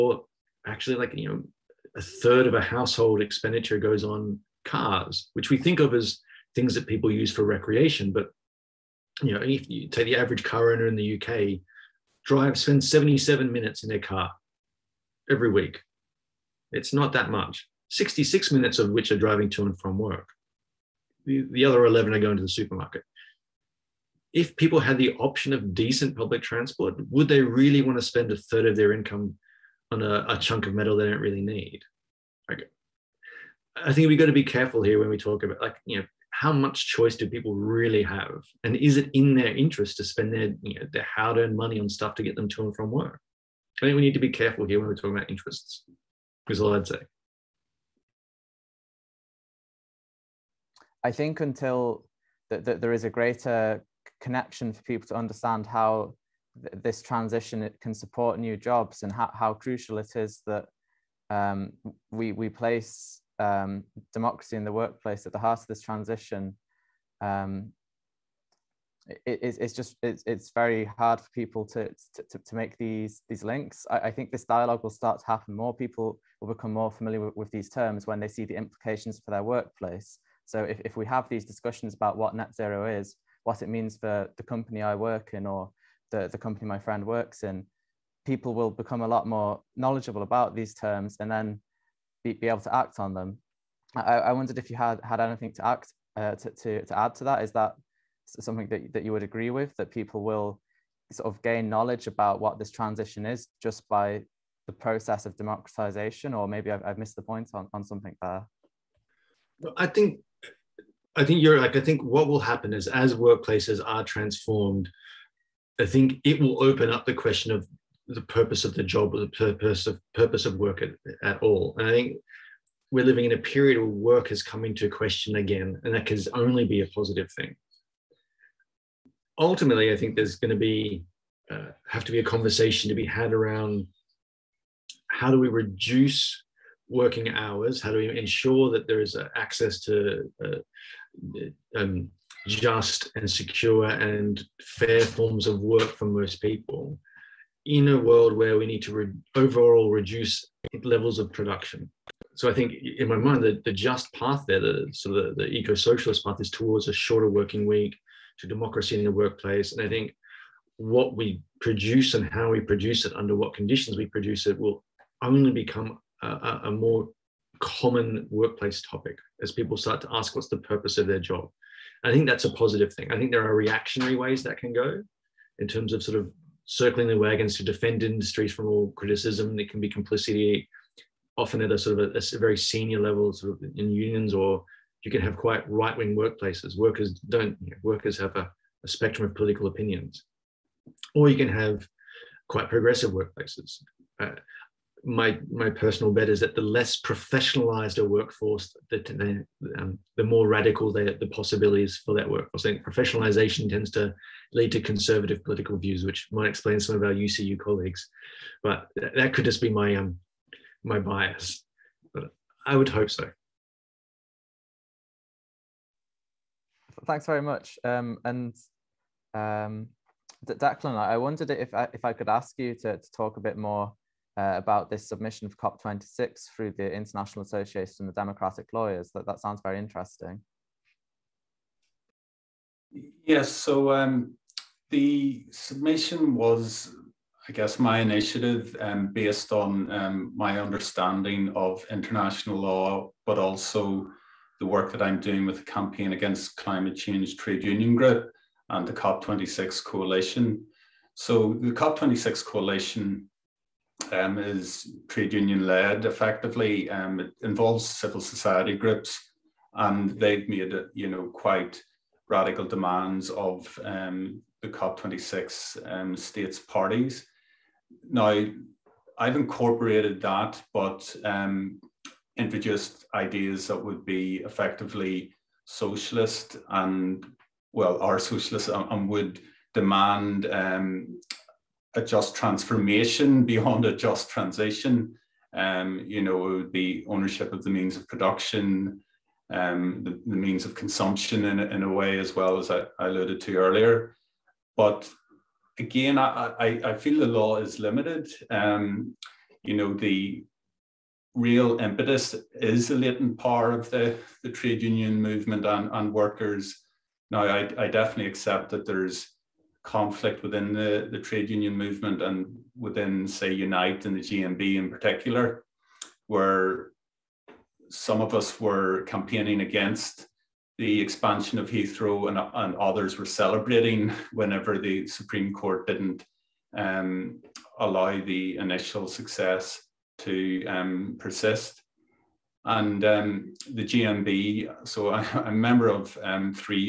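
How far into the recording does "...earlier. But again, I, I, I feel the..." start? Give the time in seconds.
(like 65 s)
293 s.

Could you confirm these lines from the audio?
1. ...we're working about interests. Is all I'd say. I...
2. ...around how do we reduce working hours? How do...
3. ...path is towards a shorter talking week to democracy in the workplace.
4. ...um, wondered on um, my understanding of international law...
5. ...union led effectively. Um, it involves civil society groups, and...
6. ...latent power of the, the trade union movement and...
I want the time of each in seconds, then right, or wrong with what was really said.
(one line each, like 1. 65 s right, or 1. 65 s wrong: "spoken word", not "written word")
1. 44 s wrong: "talking", not "working"
2. 133 s right
3. 156 s wrong: "working", not "talking"
4. 238 s wrong: "based", not "wondered"
5. 255 s right
6. 302 s right.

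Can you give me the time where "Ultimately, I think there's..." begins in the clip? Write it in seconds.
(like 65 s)
129 s.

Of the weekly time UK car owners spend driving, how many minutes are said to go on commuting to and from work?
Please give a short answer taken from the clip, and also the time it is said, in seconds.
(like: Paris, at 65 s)
66, at 17 s.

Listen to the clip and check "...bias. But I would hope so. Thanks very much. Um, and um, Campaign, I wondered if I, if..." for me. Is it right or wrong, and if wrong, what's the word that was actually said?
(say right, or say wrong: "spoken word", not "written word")
wrong: "Declan", not "Campaign".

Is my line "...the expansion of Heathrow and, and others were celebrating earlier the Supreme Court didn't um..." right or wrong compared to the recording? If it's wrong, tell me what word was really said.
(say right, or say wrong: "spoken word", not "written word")
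wrong: "whenever", not "earlier".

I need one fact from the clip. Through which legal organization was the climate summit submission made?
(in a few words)
International Association of Democratic Lawyers.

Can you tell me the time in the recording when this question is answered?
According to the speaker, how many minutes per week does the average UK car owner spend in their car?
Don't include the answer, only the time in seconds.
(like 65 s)
12 s.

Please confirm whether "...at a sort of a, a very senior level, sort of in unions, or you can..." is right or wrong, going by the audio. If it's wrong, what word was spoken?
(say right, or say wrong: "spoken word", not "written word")
right.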